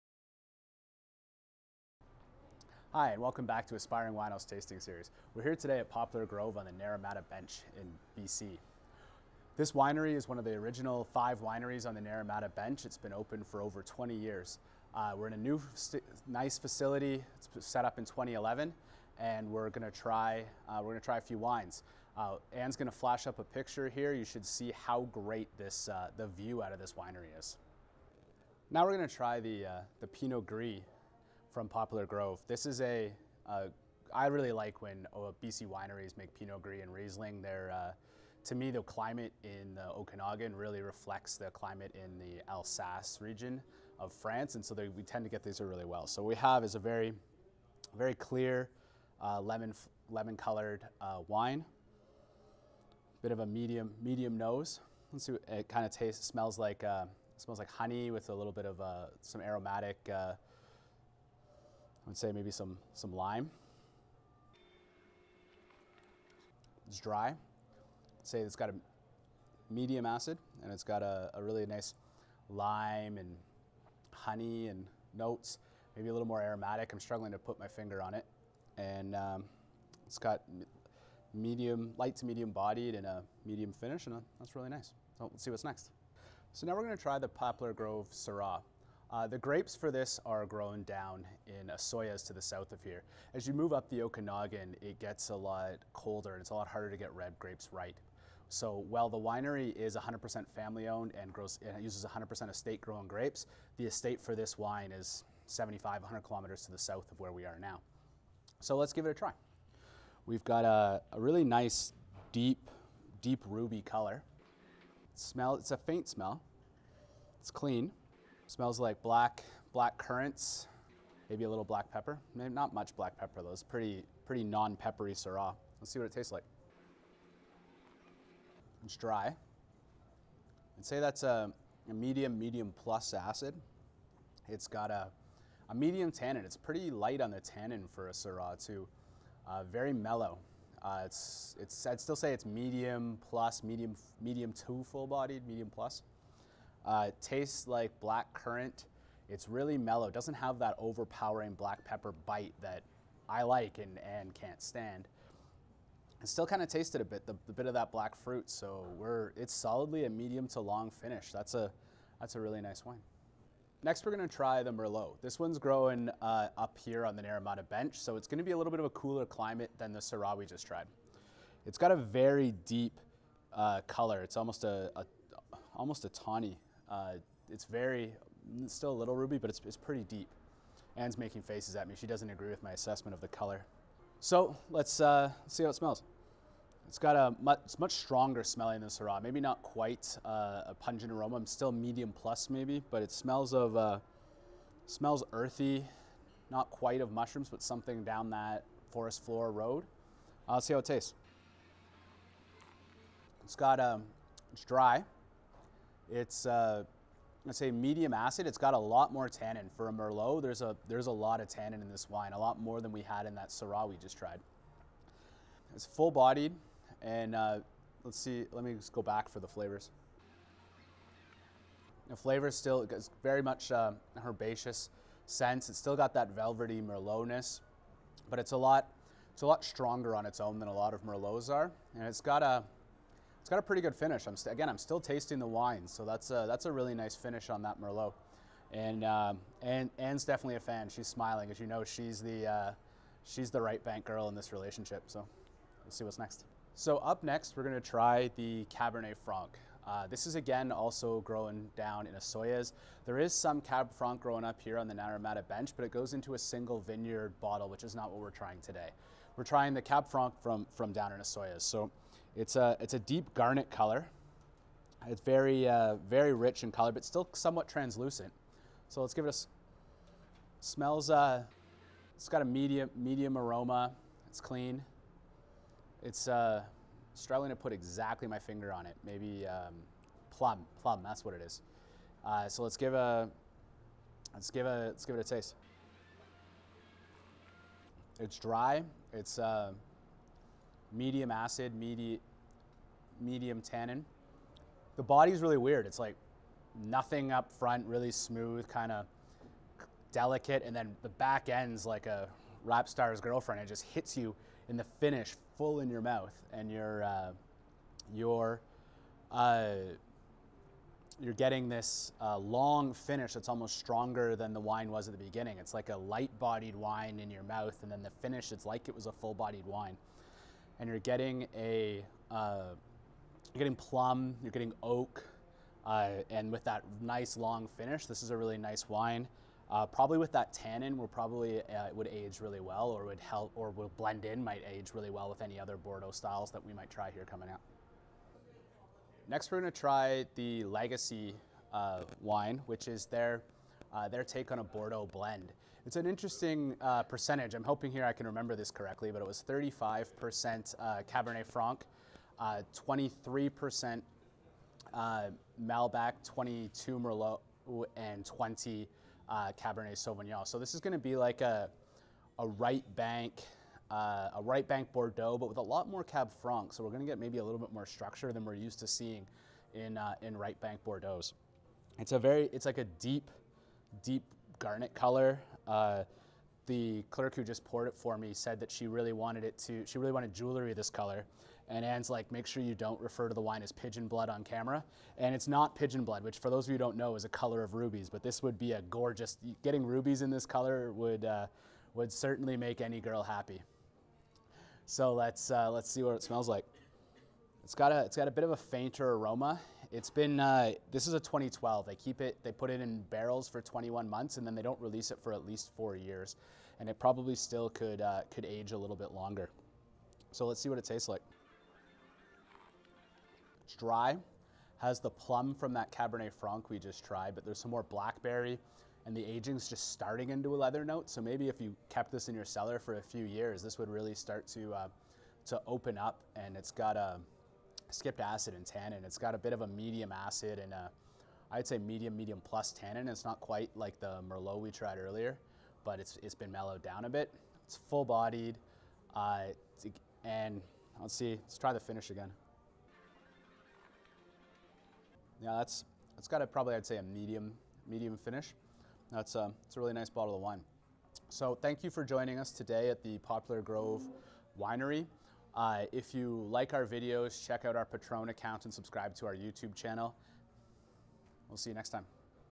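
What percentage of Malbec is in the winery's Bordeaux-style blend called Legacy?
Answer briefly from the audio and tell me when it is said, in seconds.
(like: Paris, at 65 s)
23%, at 352 s.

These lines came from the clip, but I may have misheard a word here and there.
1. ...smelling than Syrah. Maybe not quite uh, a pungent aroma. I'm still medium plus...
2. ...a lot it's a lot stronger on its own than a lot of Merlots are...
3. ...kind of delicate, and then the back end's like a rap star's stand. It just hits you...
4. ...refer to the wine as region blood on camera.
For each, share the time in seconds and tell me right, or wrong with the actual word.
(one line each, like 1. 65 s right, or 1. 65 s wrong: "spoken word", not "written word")
1. 188 s right
2. 228 s right
3. 298 s wrong: "girlfriend", not "stand"
4. 383 s wrong: "pigeon", not "region".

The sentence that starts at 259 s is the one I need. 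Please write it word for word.
We're trying the Cab Franc from, from down in Osoyoos.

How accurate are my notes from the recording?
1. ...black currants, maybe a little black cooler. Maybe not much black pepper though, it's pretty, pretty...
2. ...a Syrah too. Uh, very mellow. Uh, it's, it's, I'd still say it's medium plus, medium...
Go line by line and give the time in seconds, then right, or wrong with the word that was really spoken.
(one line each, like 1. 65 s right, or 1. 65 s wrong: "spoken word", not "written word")
1. 119 s wrong: "pepper", not "cooler"
2. 138 s right.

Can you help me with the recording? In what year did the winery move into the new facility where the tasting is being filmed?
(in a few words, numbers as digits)
2011.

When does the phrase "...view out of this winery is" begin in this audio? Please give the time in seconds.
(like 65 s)
26 s.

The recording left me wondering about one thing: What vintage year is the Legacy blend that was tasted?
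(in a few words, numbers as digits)
2012.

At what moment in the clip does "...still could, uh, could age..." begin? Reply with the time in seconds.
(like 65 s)
407 s.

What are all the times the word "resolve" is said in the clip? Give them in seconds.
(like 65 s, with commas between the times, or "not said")
not said.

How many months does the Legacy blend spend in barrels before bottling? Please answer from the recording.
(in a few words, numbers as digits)
21 months.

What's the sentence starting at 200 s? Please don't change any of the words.
i let's see how it tastes.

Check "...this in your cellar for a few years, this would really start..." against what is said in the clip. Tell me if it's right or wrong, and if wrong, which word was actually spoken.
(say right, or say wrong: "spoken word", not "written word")
right.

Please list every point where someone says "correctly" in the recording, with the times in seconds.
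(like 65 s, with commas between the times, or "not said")
348 s.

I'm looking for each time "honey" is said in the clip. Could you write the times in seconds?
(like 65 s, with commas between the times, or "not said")
57 s, 74 s.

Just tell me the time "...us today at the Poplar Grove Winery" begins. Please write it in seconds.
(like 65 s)
452 s.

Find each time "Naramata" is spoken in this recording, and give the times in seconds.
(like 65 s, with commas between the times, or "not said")
6 s, 12 s, 167 s, 254 s.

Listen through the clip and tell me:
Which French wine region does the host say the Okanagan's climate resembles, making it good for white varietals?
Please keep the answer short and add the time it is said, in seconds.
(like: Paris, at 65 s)
Alsace, at 42 s.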